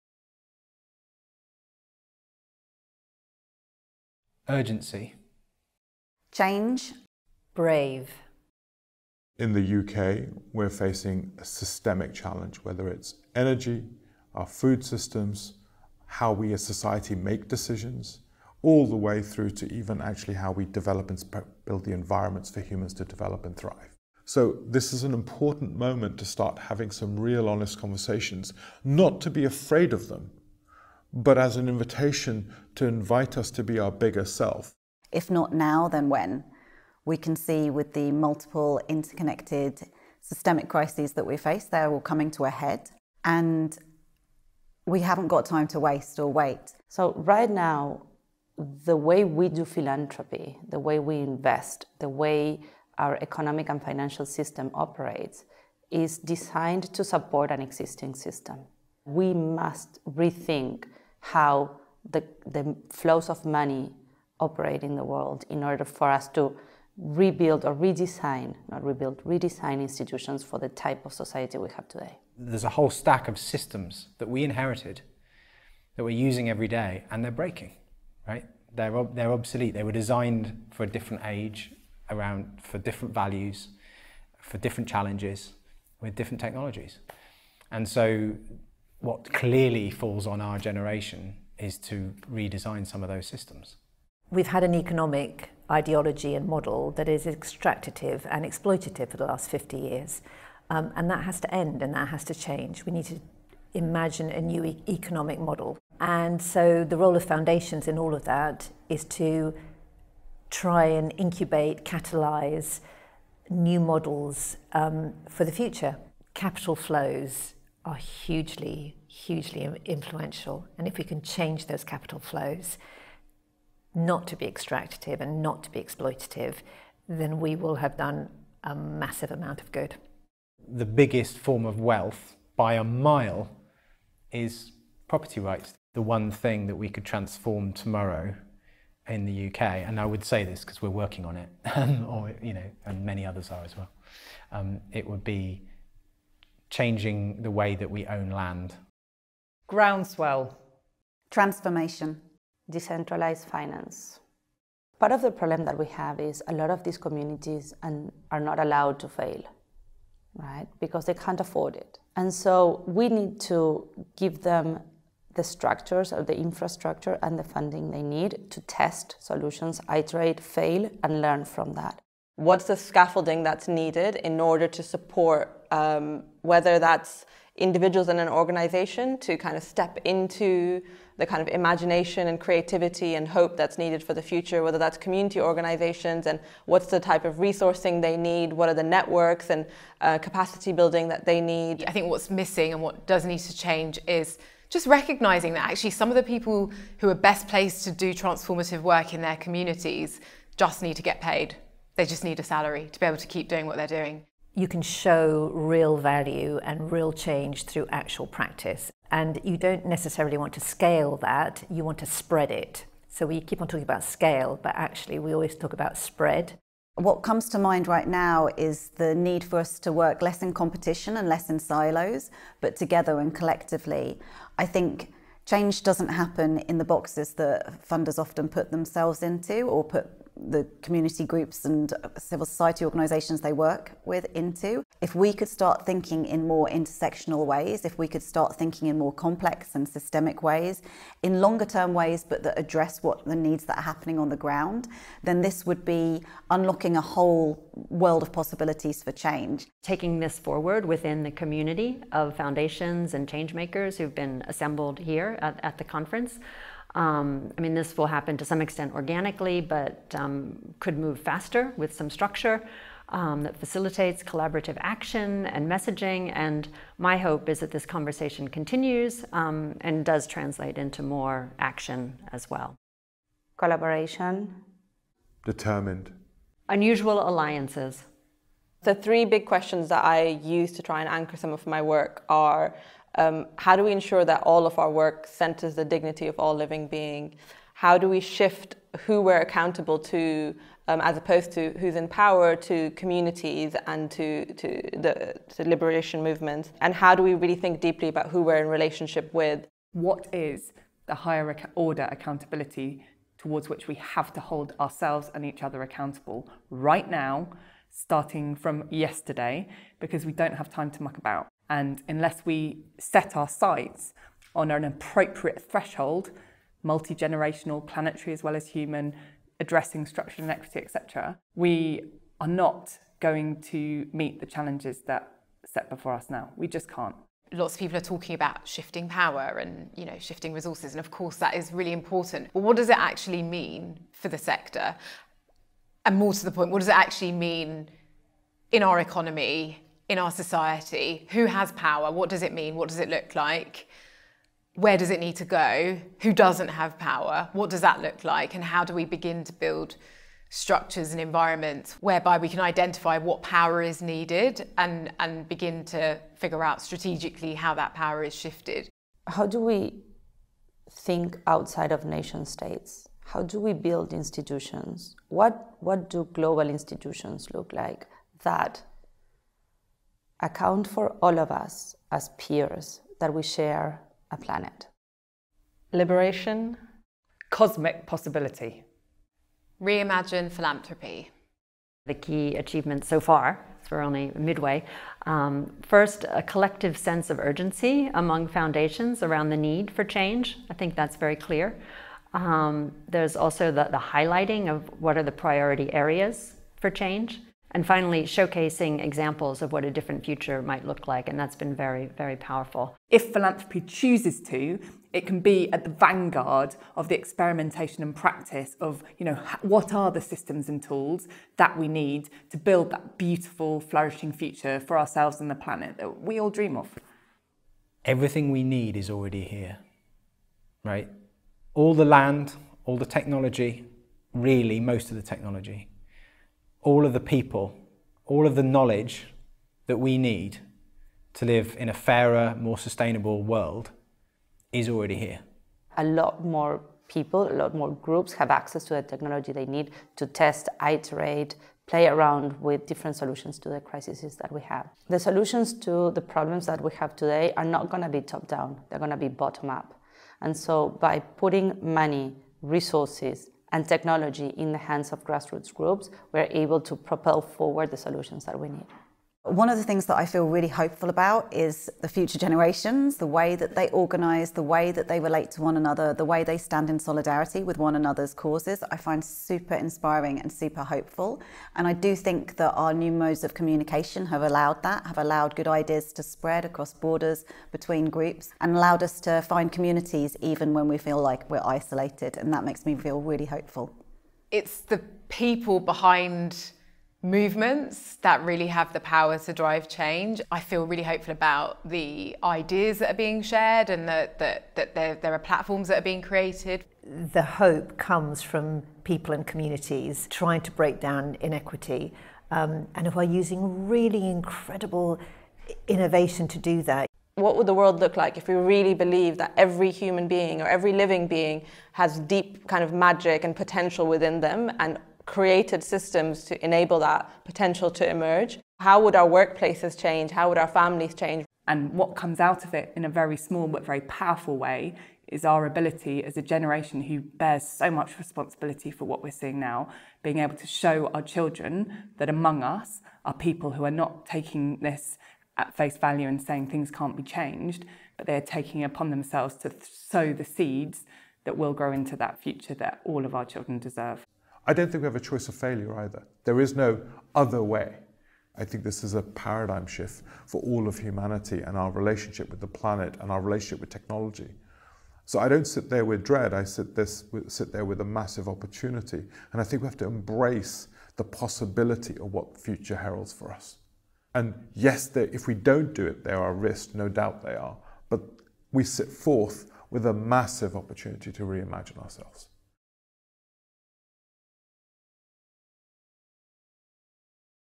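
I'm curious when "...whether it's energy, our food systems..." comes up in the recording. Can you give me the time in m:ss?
0:12.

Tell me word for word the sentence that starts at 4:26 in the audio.
And my hope is that this conversation continues um, and does translate into more action as well.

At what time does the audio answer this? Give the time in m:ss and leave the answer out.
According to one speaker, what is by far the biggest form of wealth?
2:15.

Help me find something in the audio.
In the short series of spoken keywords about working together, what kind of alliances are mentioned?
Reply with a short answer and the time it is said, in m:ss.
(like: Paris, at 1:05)
Unusual alliances, at 4:36.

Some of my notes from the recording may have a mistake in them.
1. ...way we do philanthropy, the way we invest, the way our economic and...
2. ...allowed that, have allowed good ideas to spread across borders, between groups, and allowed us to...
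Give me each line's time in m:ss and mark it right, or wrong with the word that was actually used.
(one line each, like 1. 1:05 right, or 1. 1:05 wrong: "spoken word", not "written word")
1. 0:48 right
2. 7:54 right.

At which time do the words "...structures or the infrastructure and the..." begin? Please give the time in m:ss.
2:45.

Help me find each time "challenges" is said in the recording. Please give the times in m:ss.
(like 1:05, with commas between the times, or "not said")
0:12, 1:24, 5:24.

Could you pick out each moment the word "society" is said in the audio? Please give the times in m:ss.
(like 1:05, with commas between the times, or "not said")
0:16, 1:11, 3:52, 5:40.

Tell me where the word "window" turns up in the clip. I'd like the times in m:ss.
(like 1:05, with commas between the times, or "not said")
not said.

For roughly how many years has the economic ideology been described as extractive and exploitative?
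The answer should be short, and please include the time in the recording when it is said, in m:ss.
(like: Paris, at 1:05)
50 years, at 1:39.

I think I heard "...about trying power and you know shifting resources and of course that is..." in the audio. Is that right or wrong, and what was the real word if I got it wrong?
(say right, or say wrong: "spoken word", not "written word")
wrong: "shifting", not "trying".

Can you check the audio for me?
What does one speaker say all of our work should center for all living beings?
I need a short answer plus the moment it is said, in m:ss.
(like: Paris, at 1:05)
Dignity, at 4:45.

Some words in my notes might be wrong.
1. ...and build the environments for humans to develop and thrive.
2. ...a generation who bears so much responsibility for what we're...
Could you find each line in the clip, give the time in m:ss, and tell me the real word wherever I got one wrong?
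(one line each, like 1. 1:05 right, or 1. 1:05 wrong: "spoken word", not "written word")
1. 0:21 right
2. 8:46 right.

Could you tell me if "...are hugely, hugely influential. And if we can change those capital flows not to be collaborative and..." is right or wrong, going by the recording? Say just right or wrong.
wrong.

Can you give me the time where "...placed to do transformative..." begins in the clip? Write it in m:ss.
3:17.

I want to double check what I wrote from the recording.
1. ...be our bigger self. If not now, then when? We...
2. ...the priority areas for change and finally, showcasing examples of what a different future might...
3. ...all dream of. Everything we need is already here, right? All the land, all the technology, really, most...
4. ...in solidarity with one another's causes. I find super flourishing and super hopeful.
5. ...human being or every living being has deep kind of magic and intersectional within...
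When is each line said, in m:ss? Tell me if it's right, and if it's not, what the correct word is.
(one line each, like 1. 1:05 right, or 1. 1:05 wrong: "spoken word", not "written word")
1. 0:33 right
2. 6:35 right
3. 6:56 right
4. 7:46 wrong: "inspiring", not "flourishing"
5. 8:29 wrong: "potential", not "intersectional".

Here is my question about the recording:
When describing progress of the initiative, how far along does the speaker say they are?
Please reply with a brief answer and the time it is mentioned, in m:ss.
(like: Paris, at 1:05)
Midway, at 6:24.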